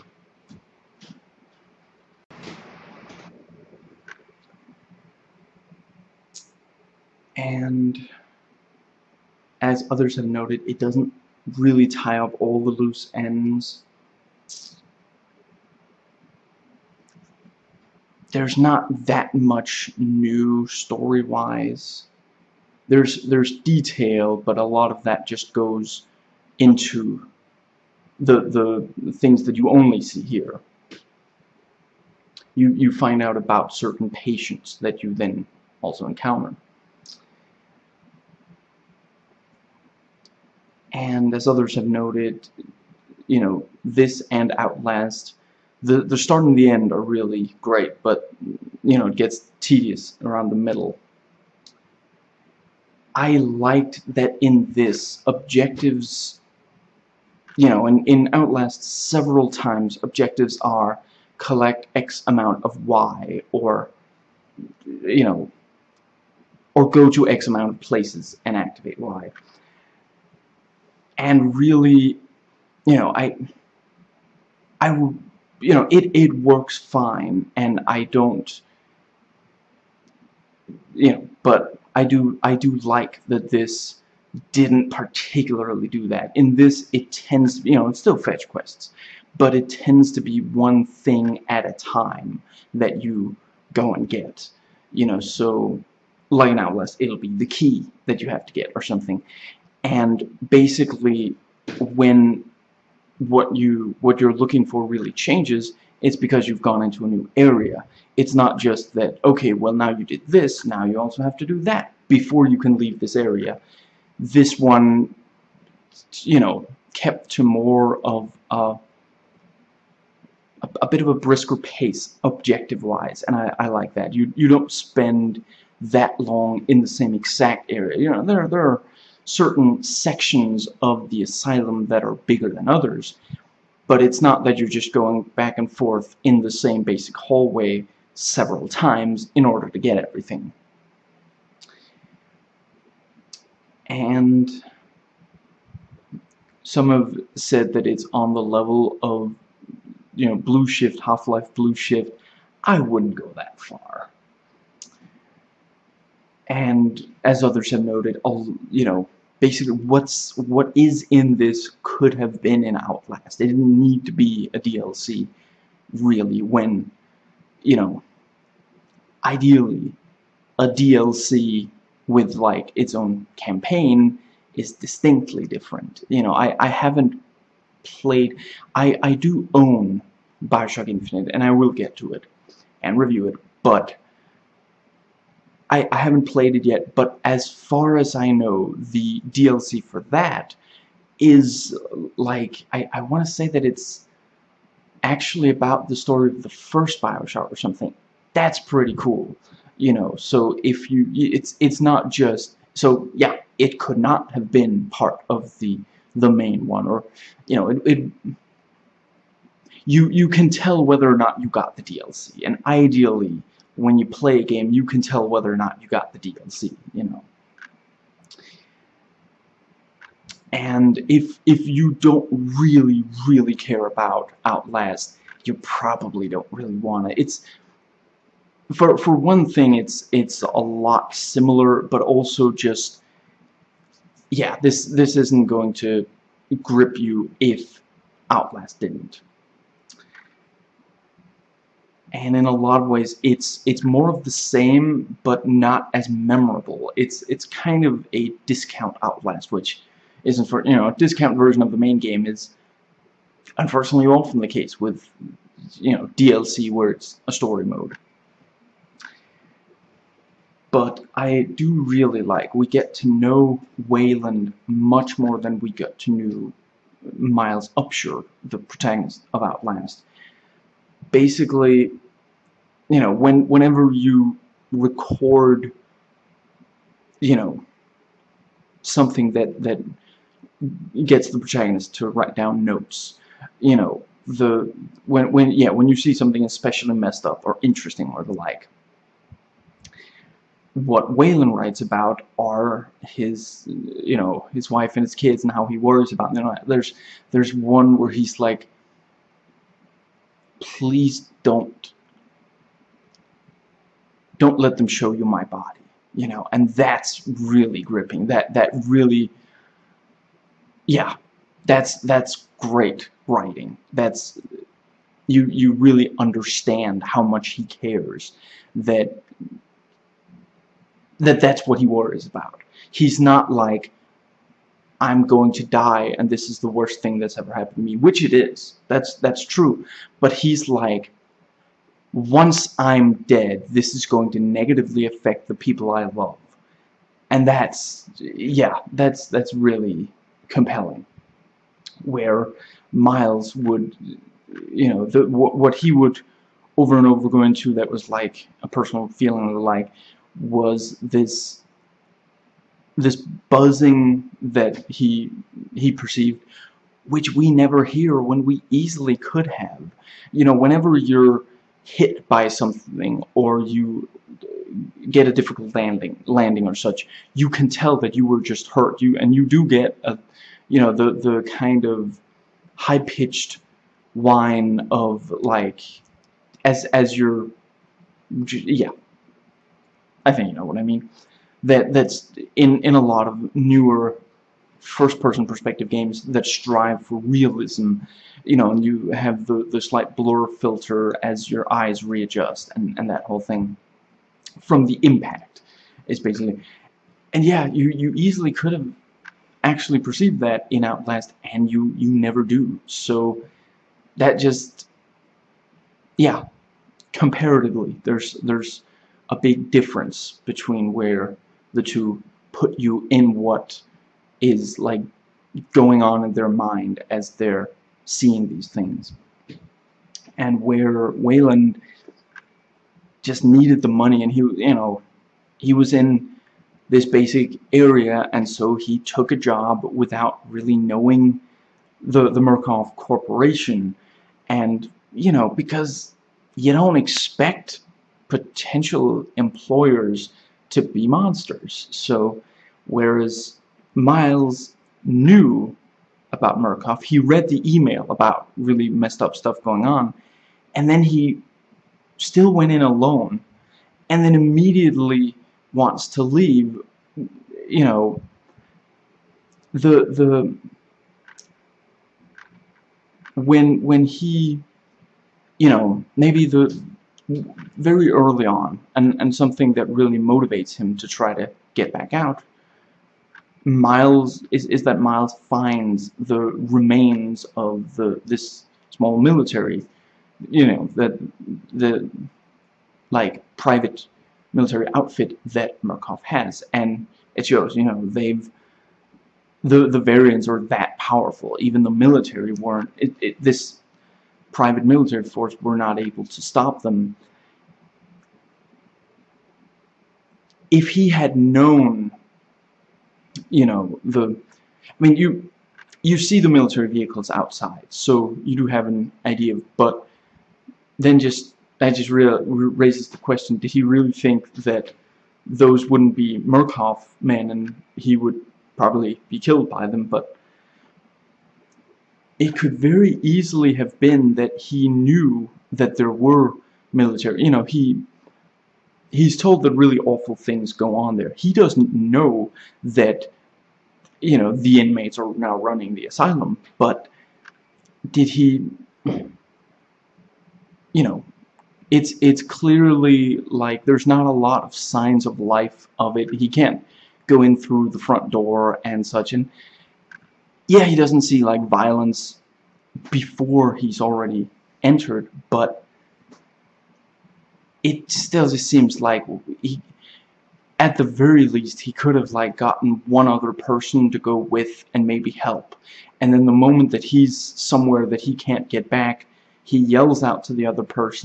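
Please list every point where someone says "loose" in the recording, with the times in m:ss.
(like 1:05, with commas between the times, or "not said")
0:12.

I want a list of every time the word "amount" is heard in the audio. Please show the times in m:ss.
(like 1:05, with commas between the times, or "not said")
1:02, 1:07.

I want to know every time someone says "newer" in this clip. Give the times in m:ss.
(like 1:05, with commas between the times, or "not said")
6:23.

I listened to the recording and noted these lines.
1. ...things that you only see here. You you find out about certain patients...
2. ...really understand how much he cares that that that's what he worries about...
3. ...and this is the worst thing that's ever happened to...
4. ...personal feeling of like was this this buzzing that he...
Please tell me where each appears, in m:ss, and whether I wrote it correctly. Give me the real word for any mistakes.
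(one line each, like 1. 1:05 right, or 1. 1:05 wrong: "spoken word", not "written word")
1. 0:29 right
2. 5:15 right
3. 5:26 right
4. 5:48 right.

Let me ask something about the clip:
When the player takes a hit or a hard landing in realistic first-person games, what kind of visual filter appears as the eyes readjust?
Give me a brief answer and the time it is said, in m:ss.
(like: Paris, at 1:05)
blur filter, at 6:30.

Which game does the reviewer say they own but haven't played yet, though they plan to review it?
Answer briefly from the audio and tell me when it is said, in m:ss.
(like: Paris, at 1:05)
Bioshock Infinite, at 3:00.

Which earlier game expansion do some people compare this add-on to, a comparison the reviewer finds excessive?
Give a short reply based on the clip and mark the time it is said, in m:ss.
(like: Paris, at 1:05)
Half-Life Blue Shift, at 2:31.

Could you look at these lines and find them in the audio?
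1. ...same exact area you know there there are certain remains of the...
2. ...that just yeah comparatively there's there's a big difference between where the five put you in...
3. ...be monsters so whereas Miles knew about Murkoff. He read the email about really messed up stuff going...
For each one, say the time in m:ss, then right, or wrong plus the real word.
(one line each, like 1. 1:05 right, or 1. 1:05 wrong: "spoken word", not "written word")
1. 2:06 wrong: "sections", not "remains"
2. 6:44 wrong: "two", not "five"
3. 7:20 right.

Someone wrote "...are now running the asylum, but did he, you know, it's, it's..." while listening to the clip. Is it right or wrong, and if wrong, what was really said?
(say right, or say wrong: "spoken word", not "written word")
right.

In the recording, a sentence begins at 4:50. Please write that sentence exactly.
What Waylon writes about are his, you know, his wife and his kids and how he worries about them.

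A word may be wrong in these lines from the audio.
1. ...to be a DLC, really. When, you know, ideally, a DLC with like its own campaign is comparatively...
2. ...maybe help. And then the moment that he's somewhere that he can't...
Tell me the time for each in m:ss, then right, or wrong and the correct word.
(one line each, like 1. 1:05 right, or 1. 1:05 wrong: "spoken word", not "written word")
1. 2:44 wrong: "distinctly", not "comparatively"
2. 9:25 right.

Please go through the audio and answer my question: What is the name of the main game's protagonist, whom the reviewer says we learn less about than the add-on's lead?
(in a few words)
Miles Upshur.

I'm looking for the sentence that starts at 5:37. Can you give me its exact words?
And that's, yeah, that's, that's really compelling.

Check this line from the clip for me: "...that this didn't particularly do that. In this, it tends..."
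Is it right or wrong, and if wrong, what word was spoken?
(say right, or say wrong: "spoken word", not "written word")
right.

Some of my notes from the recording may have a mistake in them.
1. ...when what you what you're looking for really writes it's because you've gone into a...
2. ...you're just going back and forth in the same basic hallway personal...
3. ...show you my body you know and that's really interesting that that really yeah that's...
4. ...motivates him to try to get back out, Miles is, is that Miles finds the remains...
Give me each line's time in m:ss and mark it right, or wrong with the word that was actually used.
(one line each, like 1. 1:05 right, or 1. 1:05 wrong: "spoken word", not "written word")
1. 1:41 wrong: "changes", not "writes"
2. 2:14 wrong: "several", not "personal"
3. 5:04 wrong: "gripping", not "interesting"
4. 7:50 right.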